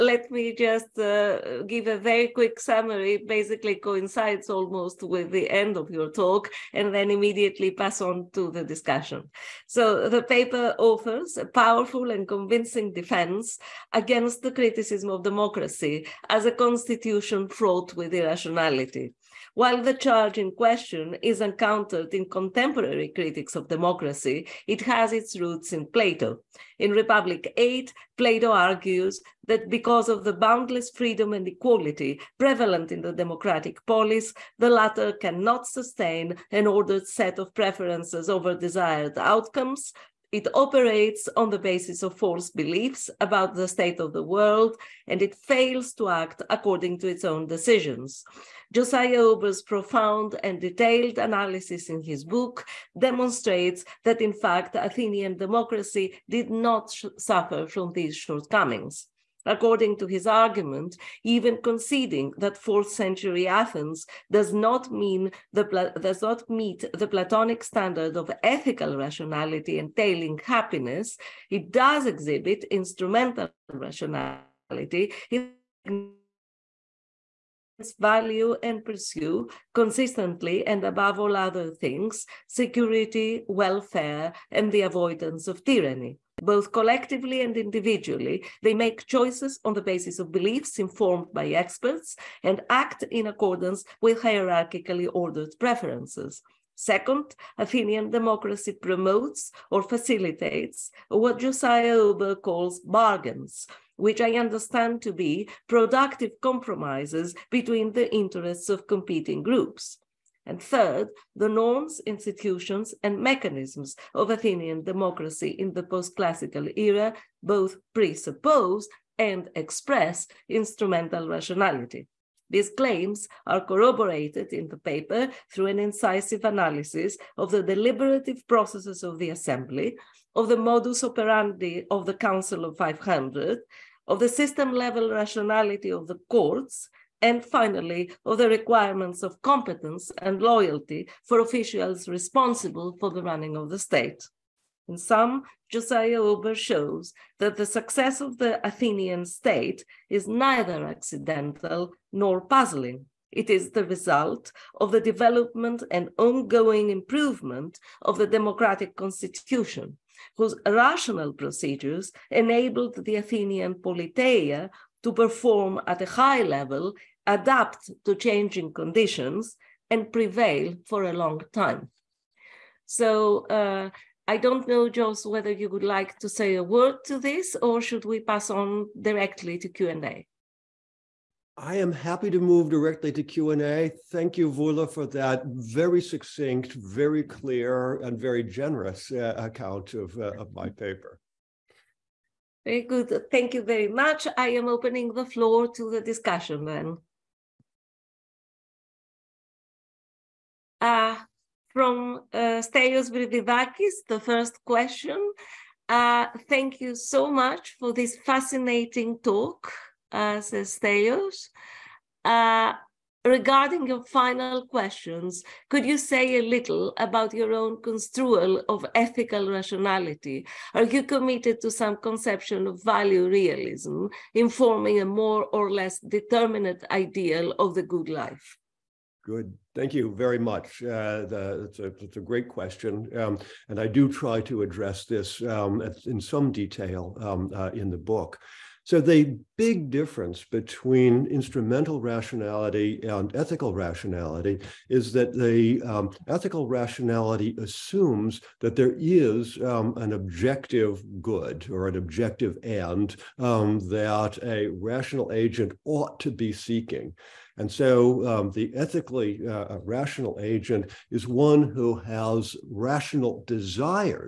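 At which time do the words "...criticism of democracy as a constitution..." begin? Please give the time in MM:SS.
00:14.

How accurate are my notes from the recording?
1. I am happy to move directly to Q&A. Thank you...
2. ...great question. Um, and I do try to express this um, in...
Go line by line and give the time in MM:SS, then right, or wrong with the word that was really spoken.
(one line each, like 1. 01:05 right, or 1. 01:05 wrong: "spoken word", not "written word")
1. 03:01 right
2. 03:52 wrong: "address", not "express".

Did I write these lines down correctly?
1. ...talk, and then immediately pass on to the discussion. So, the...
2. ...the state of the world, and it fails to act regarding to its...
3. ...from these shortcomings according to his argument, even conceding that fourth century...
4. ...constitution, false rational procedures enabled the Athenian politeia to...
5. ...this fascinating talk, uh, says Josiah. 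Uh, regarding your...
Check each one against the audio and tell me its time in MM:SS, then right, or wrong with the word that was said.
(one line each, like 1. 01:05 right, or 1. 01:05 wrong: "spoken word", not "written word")
1. 00:06 right
2. 00:43 wrong: "according", not "regarding"
3. 00:57 right
4. 02:38 wrong: "whose", not "false"
5. 03:27 wrong: "Stelios", not "Josiah".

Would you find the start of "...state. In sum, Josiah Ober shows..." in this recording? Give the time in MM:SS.
02:23.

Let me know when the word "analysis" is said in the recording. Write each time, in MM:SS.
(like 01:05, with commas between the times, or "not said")
00:51, 02:06.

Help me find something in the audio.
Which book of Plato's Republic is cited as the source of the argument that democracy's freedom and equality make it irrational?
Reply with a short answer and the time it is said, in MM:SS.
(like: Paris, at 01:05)
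Book 8, at 00:26.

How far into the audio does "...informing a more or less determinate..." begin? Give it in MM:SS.
03:44.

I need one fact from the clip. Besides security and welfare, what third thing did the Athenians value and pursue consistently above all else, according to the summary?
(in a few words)
Avoidance of tyranny.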